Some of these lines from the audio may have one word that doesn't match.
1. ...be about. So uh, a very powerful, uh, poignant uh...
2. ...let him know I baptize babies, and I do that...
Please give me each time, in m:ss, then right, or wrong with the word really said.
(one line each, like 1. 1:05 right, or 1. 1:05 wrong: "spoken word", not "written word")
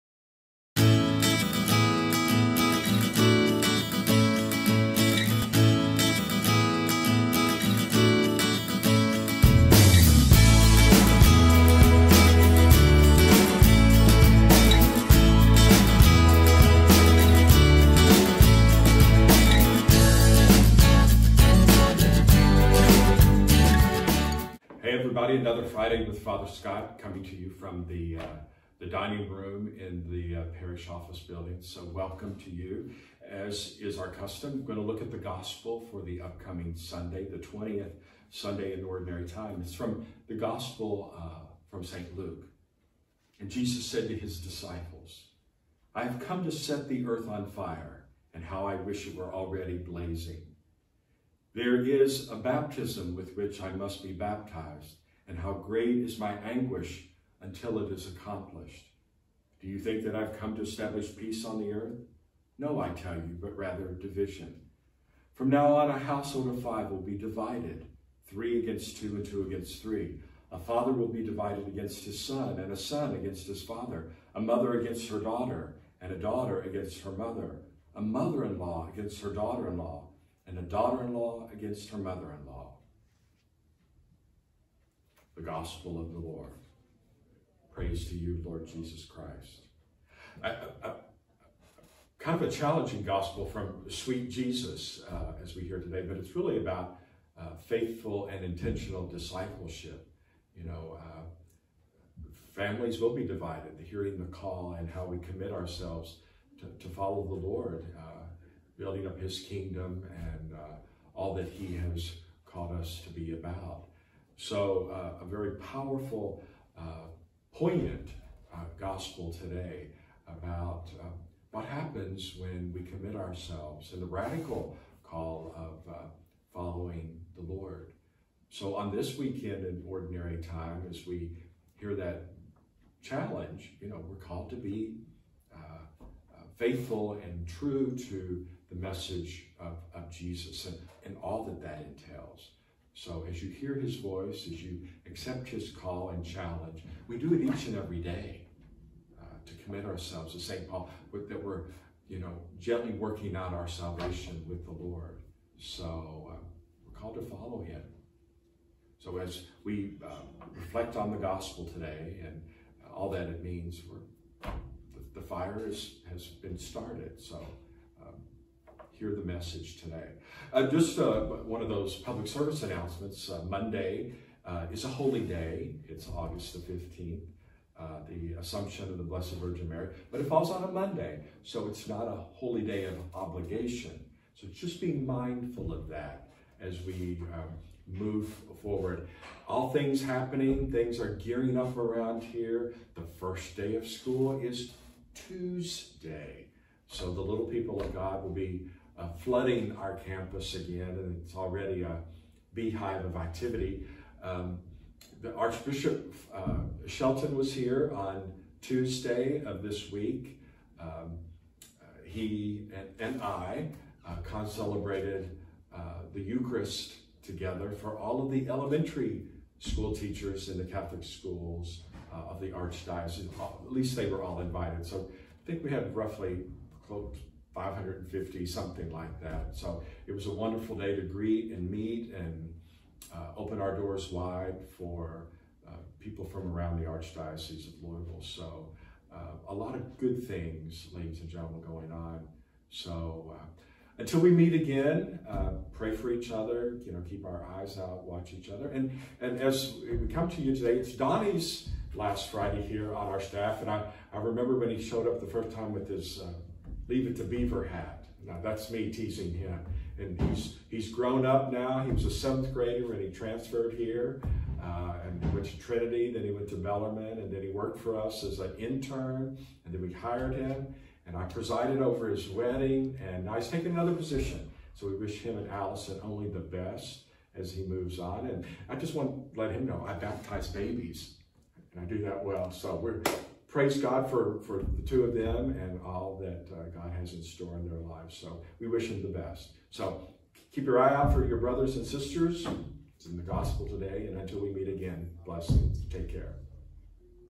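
1. 1:53 right
2. 4:39 right.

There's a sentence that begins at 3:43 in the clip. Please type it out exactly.
At least they were all invited.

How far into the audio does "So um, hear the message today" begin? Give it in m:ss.
2:47.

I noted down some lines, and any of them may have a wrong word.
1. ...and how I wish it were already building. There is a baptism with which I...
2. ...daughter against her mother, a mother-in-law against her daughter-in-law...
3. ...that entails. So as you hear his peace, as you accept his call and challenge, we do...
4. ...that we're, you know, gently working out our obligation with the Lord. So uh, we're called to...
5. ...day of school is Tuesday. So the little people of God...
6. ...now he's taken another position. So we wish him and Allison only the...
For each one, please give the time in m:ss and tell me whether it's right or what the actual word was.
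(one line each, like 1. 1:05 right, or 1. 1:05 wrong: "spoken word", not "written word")
1. 0:48 wrong: "blazing", not "building"
2. 1:16 right
3. 2:21 wrong: "voice", not "peace"
4. 2:31 wrong: "salvation", not "obligation"
5. 3:13 right
6. 4:33 right.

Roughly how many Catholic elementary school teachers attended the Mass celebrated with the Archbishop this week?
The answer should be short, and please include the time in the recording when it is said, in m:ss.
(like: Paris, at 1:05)
550, at 3:47.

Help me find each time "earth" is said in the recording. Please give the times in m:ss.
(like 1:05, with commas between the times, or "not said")
0:47, 1:01.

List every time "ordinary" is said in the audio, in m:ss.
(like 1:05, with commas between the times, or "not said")
0:38, 2:09.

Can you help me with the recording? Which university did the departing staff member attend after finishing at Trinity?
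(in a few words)
Bellarmine.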